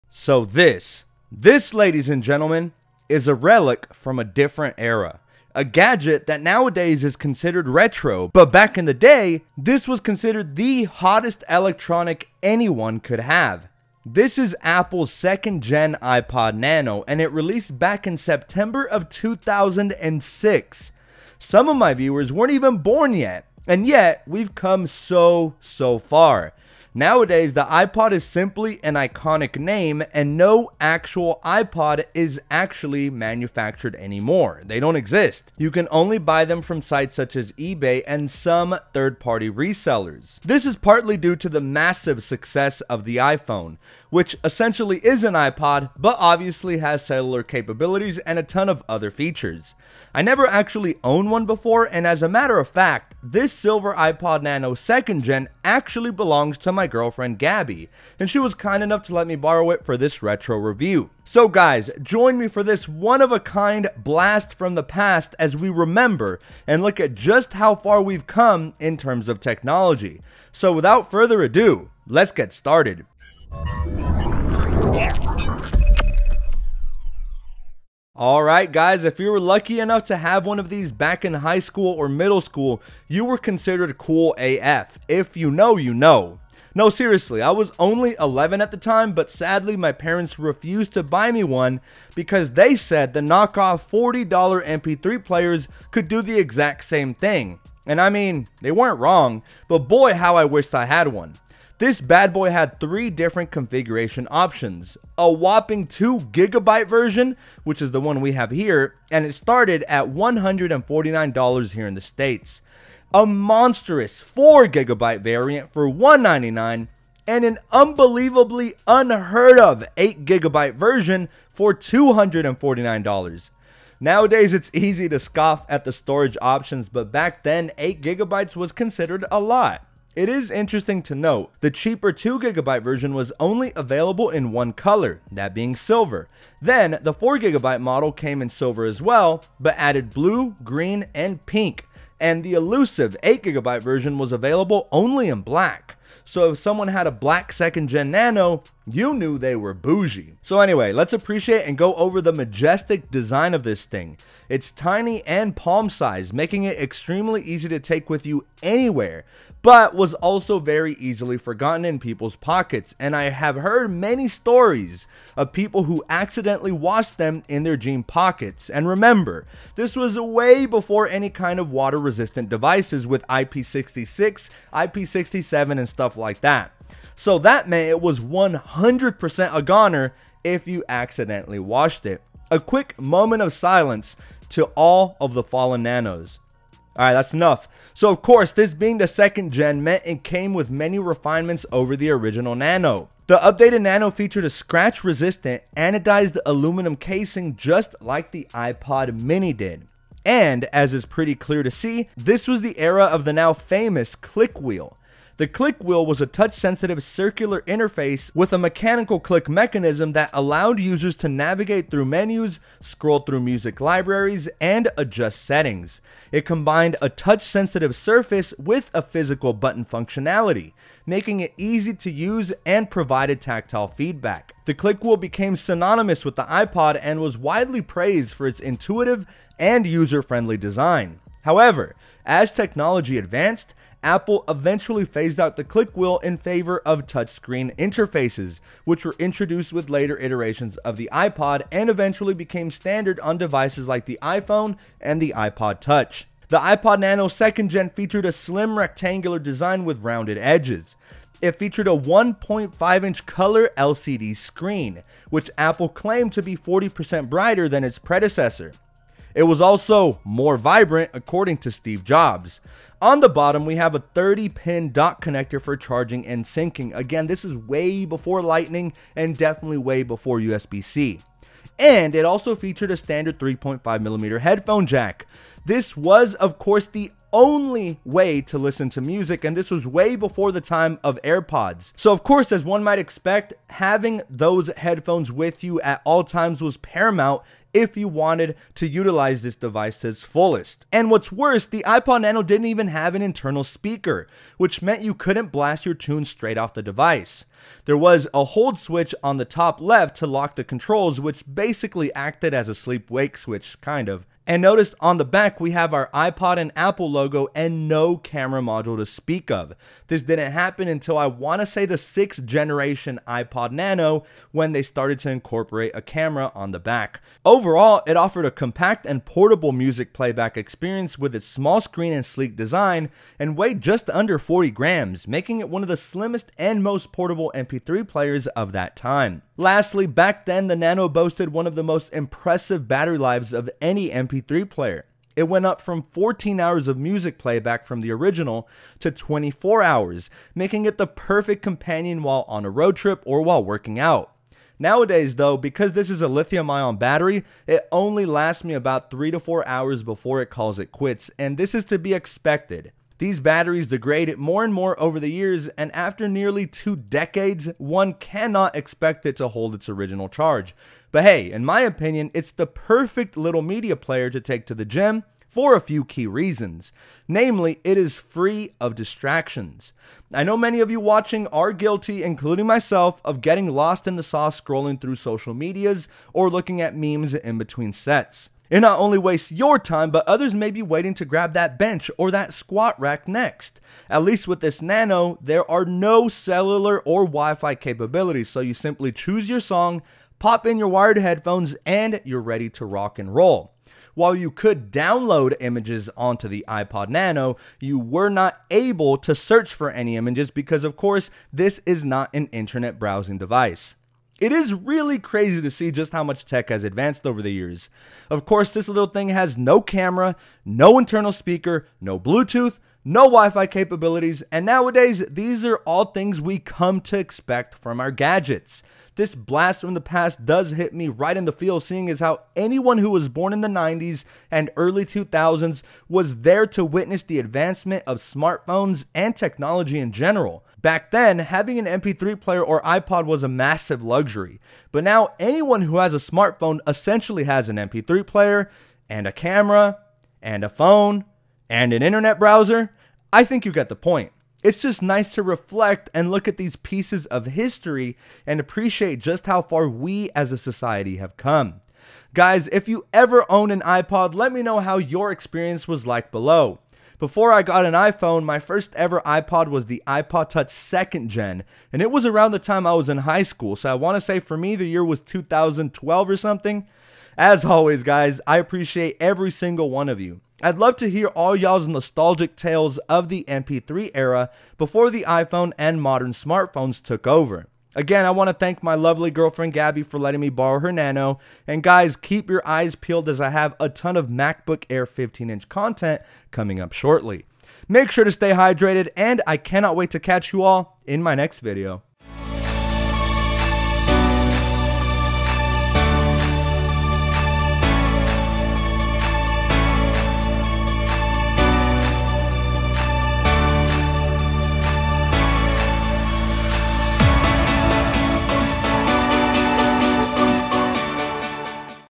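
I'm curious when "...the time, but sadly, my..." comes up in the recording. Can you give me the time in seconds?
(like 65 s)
88 s.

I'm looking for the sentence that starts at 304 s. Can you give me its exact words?
And notice on the back, we have our iPod and Apple logo and no camera module to speak of.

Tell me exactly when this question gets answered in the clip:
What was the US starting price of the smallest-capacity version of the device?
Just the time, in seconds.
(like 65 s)
110 s.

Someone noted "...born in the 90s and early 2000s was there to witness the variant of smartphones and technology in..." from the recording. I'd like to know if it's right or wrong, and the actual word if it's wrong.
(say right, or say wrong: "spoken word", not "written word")
wrong: "advancement", not "variant".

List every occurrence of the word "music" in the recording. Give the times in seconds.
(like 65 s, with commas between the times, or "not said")
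213 s, 279 s, 319 s, 336 s.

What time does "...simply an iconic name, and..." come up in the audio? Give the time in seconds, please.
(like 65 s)
28 s.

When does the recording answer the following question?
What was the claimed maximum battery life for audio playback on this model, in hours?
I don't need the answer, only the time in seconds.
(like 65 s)
339 s.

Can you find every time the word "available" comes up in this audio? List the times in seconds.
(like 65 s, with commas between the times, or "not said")
133 s, 144 s.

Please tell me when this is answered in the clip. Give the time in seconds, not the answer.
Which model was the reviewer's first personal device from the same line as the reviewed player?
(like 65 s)
460 s.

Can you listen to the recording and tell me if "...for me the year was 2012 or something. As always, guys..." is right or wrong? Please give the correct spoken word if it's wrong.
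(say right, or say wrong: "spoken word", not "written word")
right.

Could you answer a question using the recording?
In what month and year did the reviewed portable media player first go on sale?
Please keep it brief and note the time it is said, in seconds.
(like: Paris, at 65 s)
September 2006, at 18 s.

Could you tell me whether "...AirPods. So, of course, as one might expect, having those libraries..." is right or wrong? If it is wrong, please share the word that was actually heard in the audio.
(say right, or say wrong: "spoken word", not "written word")
wrong: "headphones", not "libraries".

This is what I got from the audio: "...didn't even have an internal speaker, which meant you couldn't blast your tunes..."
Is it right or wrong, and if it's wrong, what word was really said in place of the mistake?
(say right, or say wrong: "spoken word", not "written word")
right.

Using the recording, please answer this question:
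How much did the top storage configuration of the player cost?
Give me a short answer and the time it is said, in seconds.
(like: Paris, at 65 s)
$249, at 121 s.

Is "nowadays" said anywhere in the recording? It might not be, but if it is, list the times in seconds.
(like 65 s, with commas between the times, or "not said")
6 s, 26 s, 123 s, 344 s, 414 s.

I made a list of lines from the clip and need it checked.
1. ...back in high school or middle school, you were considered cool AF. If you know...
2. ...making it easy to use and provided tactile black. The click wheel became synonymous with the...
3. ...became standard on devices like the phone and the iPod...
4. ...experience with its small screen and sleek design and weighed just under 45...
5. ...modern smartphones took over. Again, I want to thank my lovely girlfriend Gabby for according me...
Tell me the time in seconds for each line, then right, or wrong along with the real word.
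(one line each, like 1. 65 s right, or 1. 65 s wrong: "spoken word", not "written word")
1. 80 s right
2. 221 s wrong: "feedback", not "black"
3. 242 s wrong: "iPhone", not "phone"
4. 320 s wrong: "40", not "45"
5. 476 s wrong: "letting", not "according".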